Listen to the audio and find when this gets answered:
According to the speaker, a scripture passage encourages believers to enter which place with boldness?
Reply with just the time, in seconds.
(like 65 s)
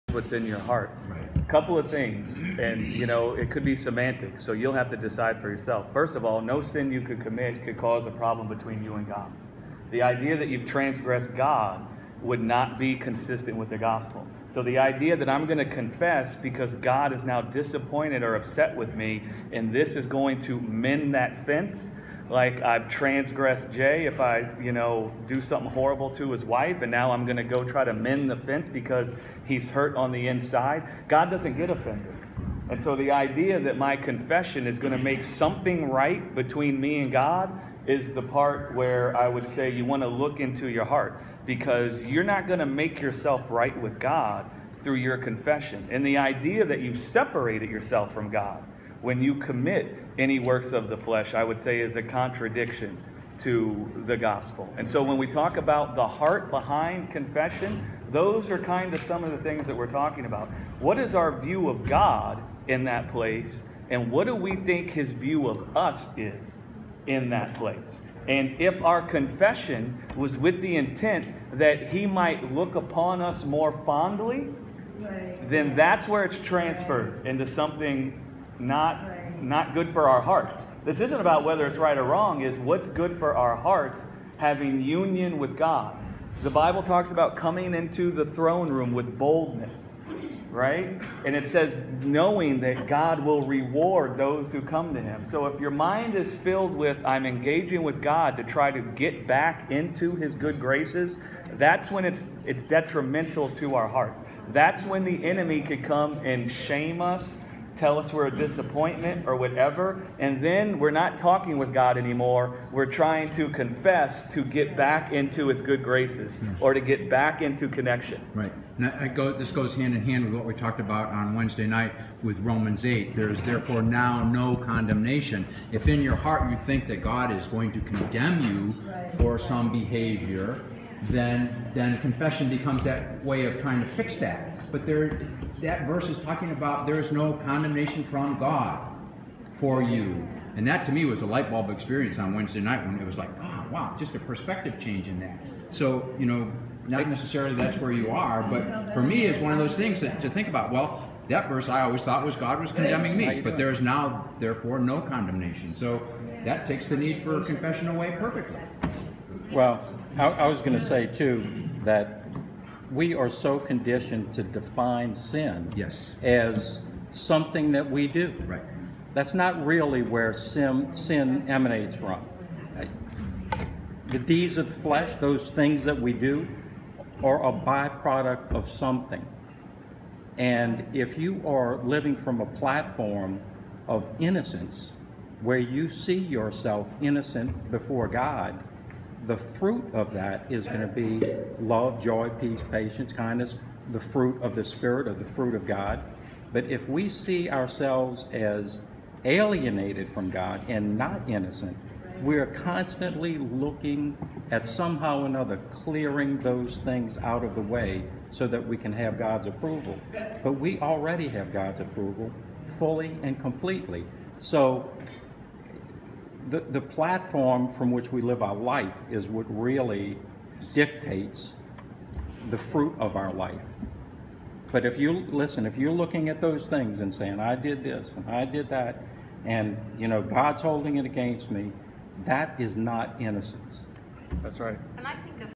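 88 s.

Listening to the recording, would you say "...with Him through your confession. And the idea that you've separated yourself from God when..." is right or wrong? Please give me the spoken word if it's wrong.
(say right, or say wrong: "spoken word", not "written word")
wrong: "God", not "Him".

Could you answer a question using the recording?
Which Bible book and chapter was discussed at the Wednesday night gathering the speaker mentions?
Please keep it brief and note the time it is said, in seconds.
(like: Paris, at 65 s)
Romans 8, at 122 s.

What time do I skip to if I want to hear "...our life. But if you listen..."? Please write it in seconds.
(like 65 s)
223 s.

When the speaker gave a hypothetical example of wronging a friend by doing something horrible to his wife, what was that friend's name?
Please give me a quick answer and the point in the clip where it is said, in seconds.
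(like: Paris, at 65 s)
Jay, at 23 s.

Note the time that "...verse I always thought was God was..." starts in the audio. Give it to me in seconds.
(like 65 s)
151 s.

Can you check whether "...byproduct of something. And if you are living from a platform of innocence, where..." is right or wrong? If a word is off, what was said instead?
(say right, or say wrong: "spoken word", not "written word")
right.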